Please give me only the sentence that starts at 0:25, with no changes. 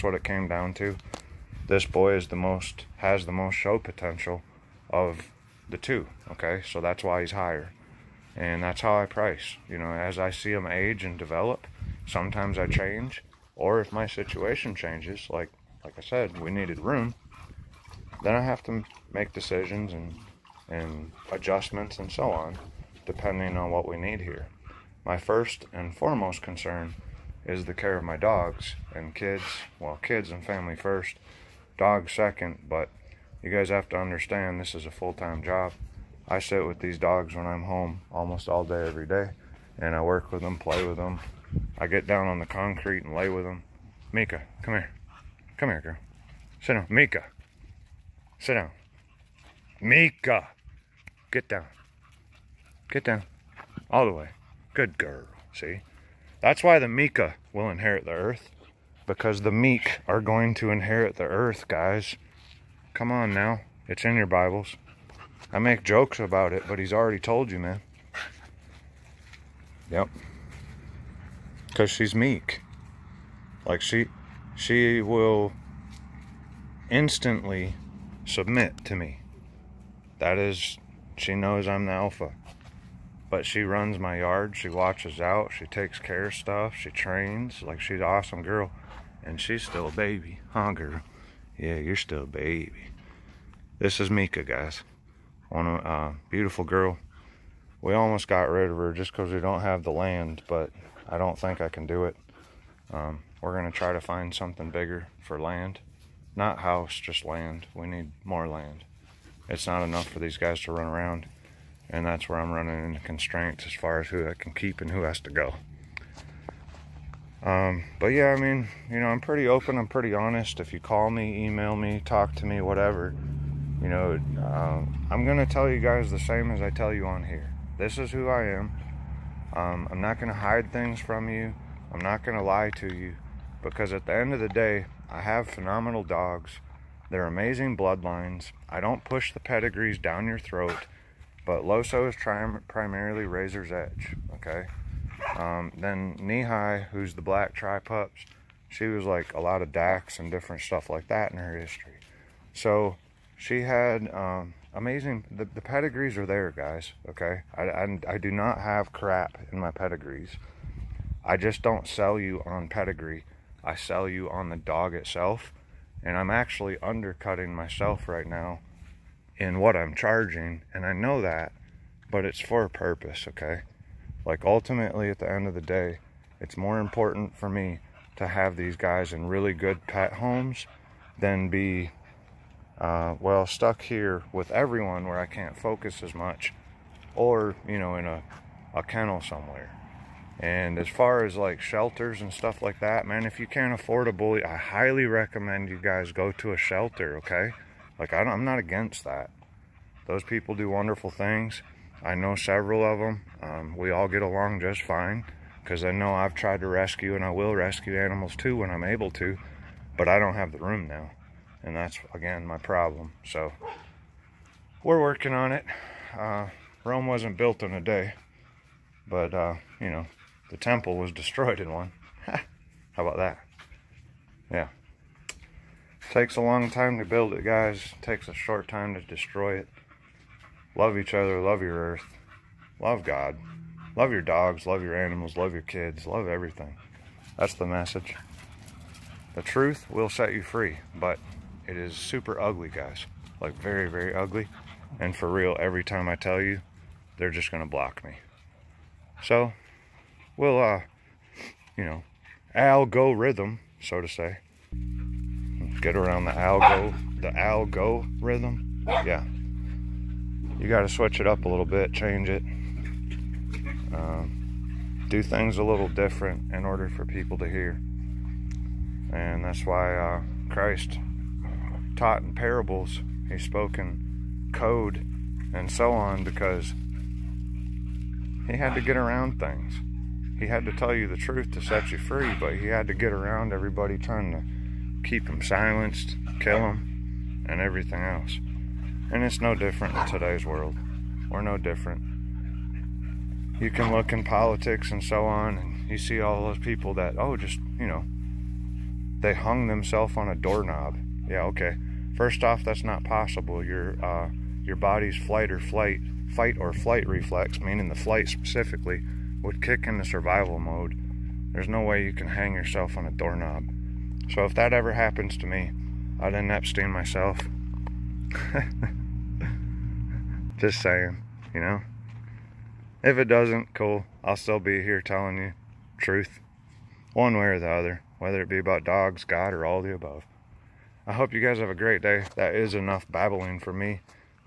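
My first and foremost concern is the care of my dogs and kids.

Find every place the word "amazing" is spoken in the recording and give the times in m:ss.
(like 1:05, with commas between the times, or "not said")
2:17, 2:34.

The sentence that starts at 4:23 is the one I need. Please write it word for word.
Uh, do things a little different in order for people to hear.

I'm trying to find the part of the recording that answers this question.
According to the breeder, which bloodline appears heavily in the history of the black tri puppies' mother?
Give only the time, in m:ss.
2:29.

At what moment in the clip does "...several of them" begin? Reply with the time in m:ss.
3:22.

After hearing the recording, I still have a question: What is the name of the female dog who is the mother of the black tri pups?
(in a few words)
High.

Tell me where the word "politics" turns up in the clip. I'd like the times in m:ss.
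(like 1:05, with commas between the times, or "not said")
4:54.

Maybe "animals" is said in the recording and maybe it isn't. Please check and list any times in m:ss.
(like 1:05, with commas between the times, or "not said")
3:28, 3:54.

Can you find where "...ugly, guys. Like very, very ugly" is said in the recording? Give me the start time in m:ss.
4:02.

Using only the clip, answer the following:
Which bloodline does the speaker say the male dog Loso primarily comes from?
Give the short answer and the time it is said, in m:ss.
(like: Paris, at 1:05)
Razor's Edge, at 2:23.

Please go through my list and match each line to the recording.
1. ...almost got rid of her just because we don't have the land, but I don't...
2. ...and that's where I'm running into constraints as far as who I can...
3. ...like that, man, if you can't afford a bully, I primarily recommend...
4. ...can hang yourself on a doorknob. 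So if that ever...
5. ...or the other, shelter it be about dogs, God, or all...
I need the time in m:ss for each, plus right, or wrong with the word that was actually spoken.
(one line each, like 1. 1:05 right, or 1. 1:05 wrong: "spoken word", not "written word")
1. 1:37 right
2. 1:51 right
3. 3:12 wrong: "highly", not "primarily"
4. 5:12 right
5. 5:27 wrong: "whether", not "shelter".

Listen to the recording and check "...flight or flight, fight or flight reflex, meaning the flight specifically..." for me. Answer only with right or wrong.
right.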